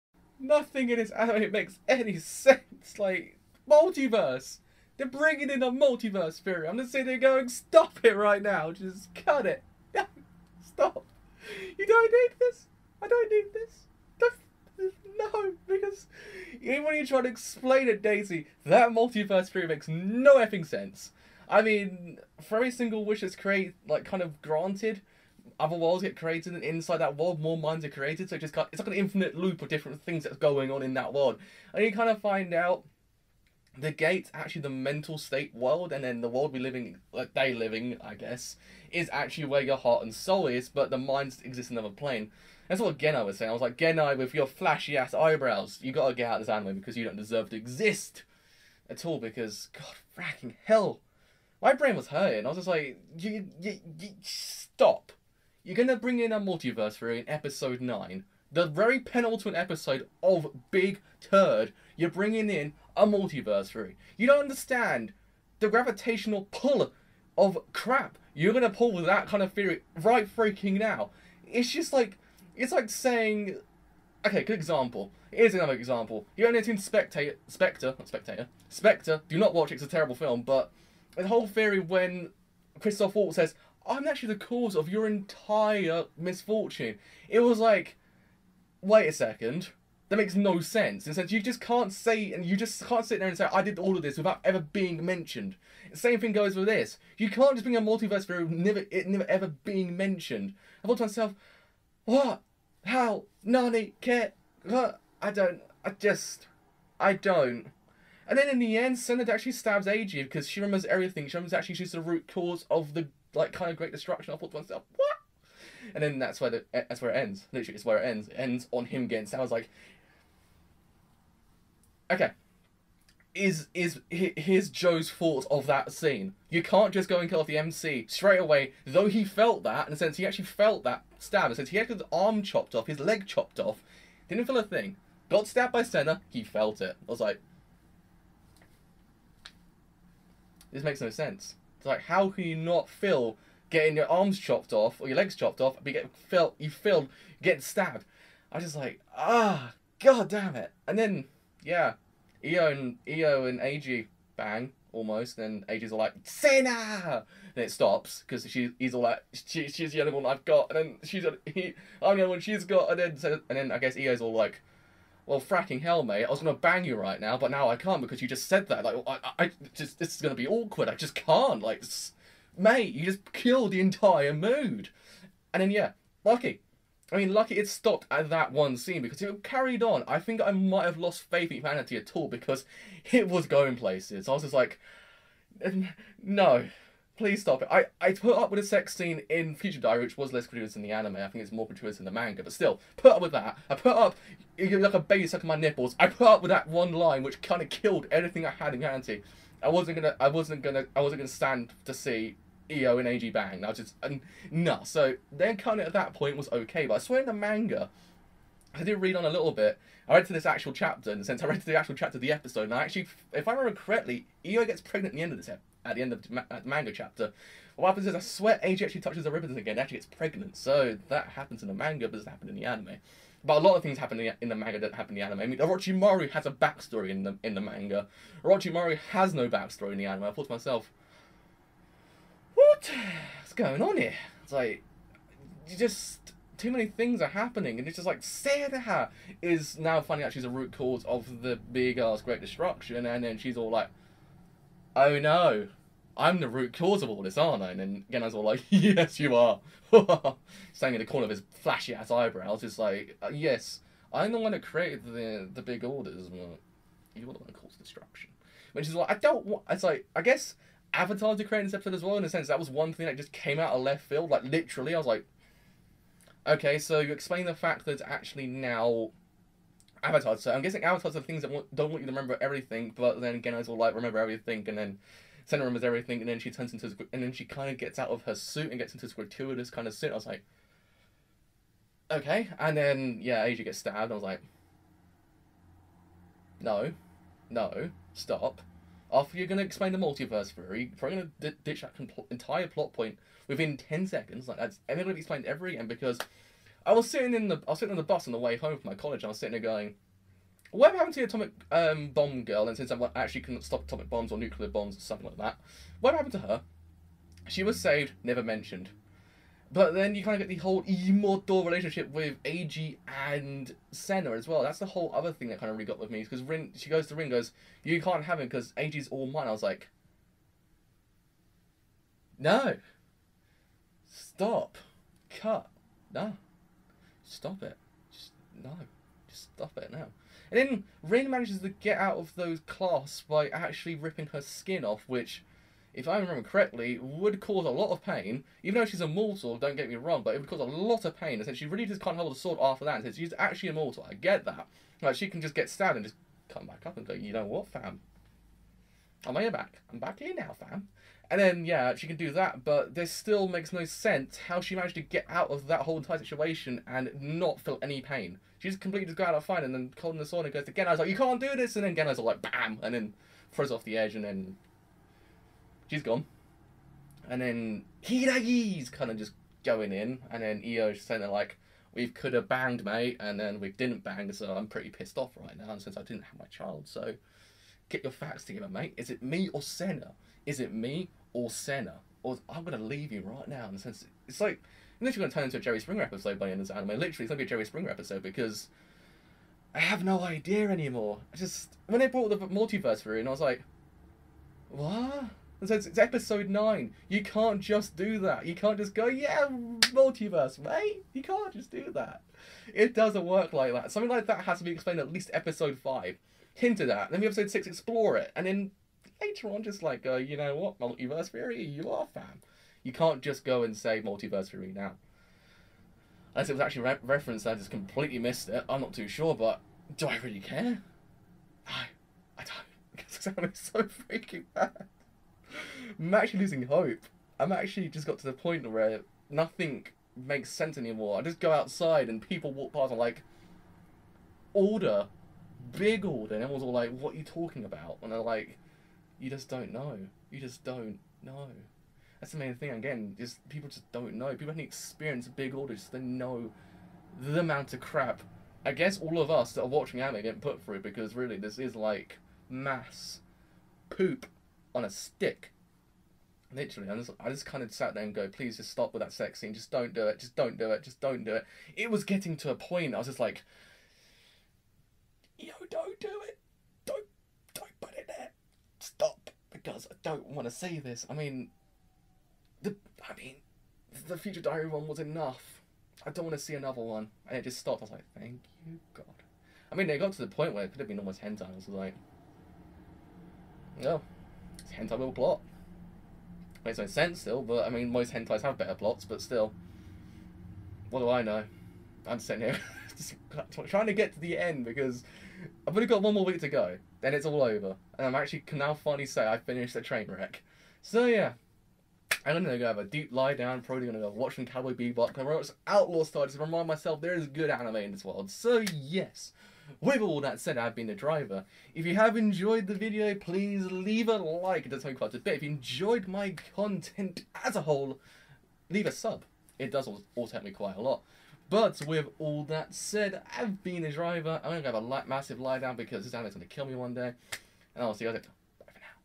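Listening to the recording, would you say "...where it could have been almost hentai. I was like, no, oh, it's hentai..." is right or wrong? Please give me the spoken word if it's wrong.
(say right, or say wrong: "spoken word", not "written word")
right.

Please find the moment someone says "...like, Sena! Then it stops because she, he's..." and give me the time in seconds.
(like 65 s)
155 s.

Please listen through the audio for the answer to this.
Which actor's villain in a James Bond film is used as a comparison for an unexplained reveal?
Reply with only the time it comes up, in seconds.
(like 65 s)
82 s.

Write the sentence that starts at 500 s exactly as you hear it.
So yeah, I'm gonna go have a deep lie down.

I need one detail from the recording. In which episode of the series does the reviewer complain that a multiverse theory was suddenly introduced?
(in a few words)
9.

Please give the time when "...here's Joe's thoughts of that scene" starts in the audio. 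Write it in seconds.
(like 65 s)
124 s.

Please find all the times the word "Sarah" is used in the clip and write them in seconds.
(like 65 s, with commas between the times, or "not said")
238 s.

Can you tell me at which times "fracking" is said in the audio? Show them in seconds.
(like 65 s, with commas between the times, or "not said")
50 s, 165 s.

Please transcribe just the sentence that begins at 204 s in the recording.
So then kind of at that point was okay, but I swear in the manga, I did read on a little bit.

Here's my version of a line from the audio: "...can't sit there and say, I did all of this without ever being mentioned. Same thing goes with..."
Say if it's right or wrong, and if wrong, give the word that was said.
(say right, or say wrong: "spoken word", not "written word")
right.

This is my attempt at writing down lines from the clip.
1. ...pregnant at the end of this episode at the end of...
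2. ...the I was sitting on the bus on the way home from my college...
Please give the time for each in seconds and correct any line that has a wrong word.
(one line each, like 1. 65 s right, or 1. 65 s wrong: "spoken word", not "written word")
1. 214 s right
2. 297 s right.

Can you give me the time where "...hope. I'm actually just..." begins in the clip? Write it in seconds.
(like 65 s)
426 s.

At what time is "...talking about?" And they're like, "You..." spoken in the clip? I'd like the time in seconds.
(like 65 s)
437 s.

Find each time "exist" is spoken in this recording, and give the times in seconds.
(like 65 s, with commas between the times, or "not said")
41 s, 47 s.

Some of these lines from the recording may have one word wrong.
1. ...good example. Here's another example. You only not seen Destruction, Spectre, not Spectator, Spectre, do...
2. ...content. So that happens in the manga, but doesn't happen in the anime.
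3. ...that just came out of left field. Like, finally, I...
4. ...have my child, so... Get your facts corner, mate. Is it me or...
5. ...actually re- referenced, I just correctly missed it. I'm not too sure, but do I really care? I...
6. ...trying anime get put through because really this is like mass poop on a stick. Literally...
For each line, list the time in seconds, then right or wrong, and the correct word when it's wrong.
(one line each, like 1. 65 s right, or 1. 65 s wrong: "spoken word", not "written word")
1. 74 s wrong: "Spectator", not "Destruction"
2. 220 s wrong: "pregnant", not "content"
3. 263 s wrong: "literally", not "finally"
4. 376 s wrong: "together", not "corner"
5. 416 s wrong: "completely", not "correctly"
6. 449 s wrong: "watching", not "trying".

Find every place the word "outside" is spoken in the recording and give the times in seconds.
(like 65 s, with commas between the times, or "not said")
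431 s.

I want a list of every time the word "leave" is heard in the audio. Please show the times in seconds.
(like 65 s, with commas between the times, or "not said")
382 s, 513 s, 518 s.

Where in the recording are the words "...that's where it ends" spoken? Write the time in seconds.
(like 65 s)
116 s.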